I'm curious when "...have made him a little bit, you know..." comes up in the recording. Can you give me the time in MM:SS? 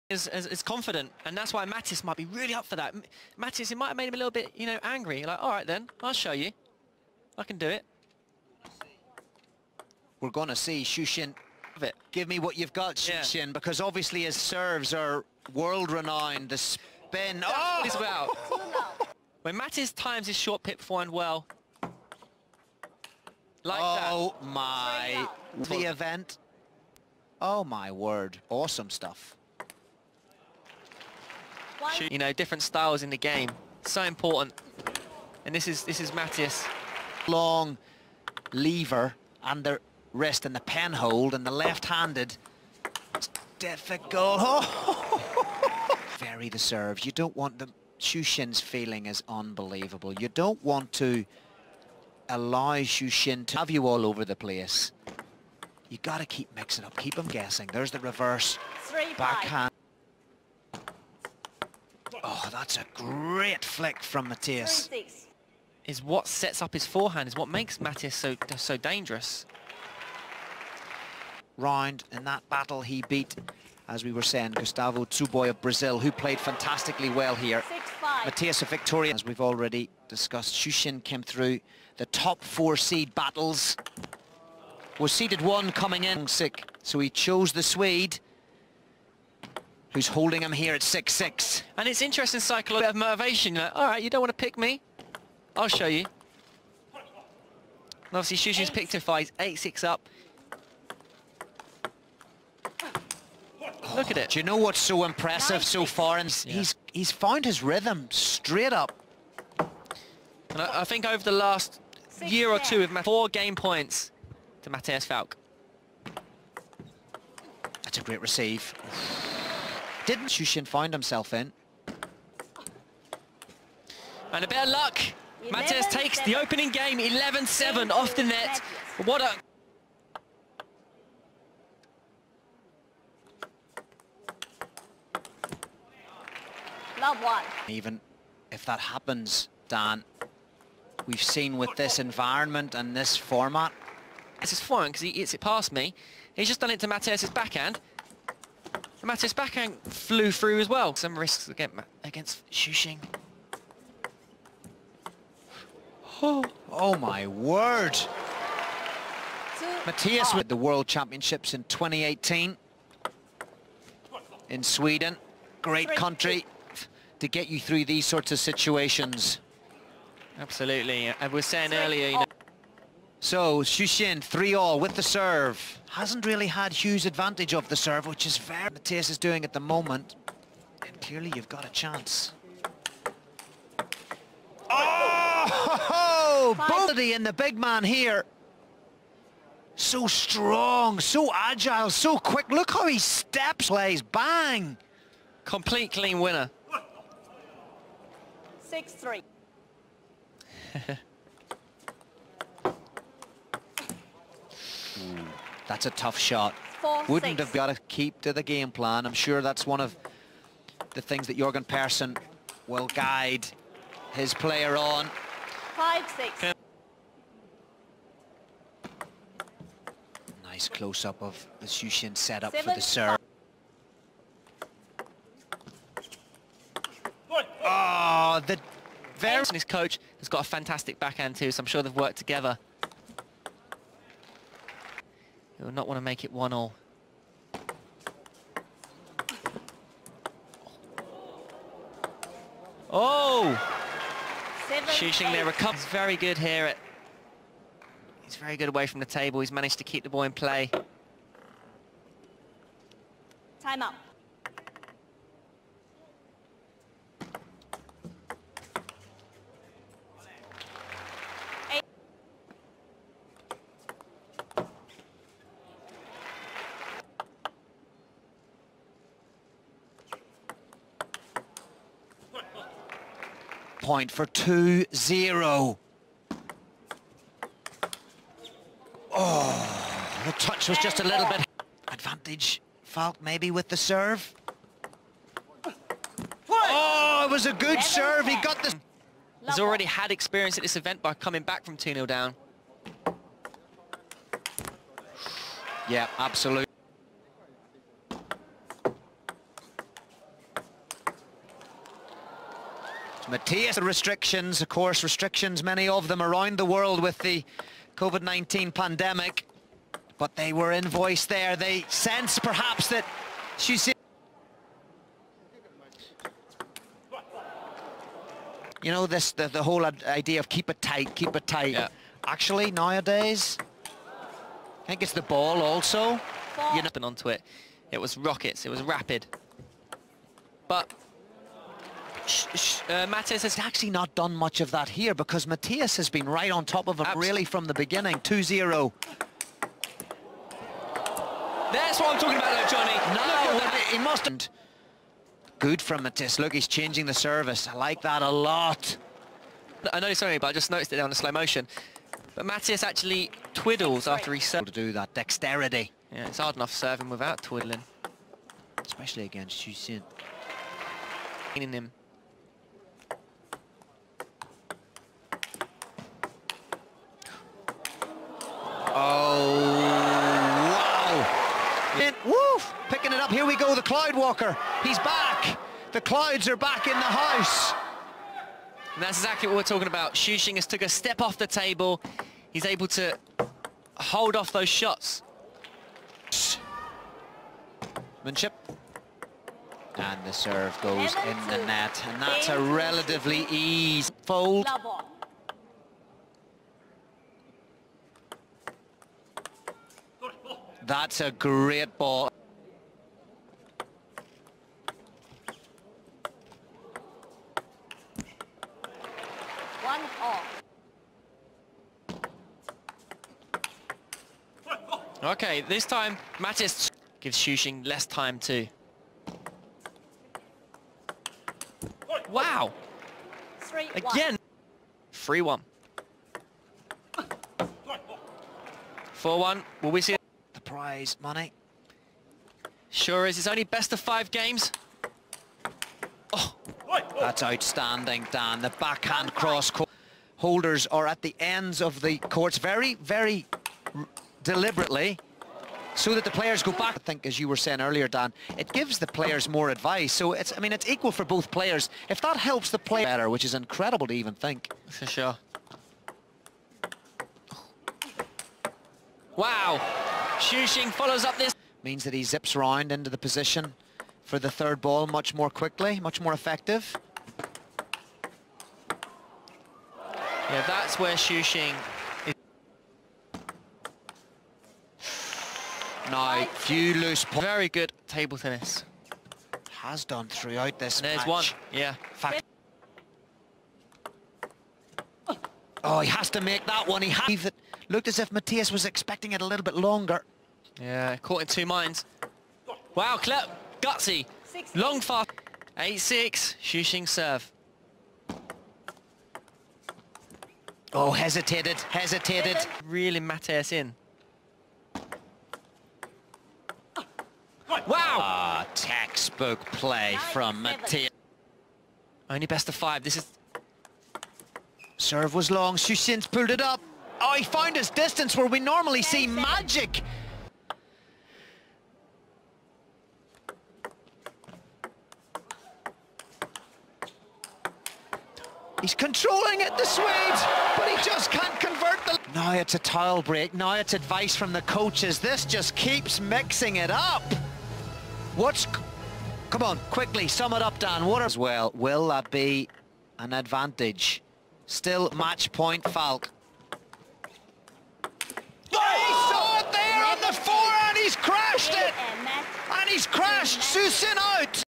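00:03.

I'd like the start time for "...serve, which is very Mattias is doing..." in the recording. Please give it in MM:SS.
02:57.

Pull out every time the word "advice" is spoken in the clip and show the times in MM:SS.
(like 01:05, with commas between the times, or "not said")
07:29, 08:53.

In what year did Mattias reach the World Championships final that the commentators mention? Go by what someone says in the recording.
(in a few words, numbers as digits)
2018.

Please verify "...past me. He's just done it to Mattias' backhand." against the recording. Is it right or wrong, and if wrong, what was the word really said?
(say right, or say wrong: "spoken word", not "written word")
right.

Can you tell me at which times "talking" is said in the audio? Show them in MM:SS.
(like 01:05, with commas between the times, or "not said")
05:42, 06:19.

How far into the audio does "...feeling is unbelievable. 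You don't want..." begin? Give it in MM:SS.
00:48.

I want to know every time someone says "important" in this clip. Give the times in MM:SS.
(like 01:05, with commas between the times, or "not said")
00:34.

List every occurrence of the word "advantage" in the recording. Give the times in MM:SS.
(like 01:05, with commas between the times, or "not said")
02:57, 04:41, 09:03.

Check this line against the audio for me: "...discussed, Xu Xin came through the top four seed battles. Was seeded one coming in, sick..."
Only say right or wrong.
right.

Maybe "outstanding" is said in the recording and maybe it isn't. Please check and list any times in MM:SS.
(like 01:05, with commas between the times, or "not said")
07:17.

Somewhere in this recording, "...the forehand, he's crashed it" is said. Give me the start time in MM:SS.
09:10.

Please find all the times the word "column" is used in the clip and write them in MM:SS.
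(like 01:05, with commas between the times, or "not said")
not said.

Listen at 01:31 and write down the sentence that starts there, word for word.
And it's interesting cycle of motivation.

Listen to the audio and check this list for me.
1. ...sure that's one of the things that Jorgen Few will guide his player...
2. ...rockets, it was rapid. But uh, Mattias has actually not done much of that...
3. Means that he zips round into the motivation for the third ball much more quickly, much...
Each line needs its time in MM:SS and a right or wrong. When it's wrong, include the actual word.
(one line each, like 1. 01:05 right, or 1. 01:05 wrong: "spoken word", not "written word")
1. 03:29 wrong: "Persson", not "Few"
2. 05:28 right
3. 07:41 wrong: "position", not "motivation".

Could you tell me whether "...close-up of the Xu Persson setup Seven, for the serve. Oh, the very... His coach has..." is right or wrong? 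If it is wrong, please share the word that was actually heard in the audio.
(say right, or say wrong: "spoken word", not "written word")
wrong: "Xin", not "Persson".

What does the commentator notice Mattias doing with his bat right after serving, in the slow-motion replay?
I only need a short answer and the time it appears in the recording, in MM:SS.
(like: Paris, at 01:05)
twiddles, at 05:53.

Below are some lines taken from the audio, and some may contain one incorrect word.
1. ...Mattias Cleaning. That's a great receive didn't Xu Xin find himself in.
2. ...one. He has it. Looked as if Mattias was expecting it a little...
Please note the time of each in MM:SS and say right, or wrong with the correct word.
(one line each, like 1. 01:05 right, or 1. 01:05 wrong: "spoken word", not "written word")
1. 01:54 wrong: "Falck", not "Cleaning"
2. 08:06 right.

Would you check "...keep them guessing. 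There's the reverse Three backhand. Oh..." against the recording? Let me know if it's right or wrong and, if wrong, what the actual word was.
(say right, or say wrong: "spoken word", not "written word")
right.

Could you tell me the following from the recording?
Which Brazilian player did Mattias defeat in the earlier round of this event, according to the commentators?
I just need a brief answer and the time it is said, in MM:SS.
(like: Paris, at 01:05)
Gustavo Tsuboi, at 01:14.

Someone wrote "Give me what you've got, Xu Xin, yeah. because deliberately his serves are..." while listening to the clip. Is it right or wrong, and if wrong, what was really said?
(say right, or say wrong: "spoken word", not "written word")
wrong: "obviously", not "deliberately".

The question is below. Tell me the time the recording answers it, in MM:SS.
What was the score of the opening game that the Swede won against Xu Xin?
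02:06.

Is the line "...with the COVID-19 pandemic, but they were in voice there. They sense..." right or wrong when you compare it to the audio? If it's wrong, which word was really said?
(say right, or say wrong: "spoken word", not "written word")
right.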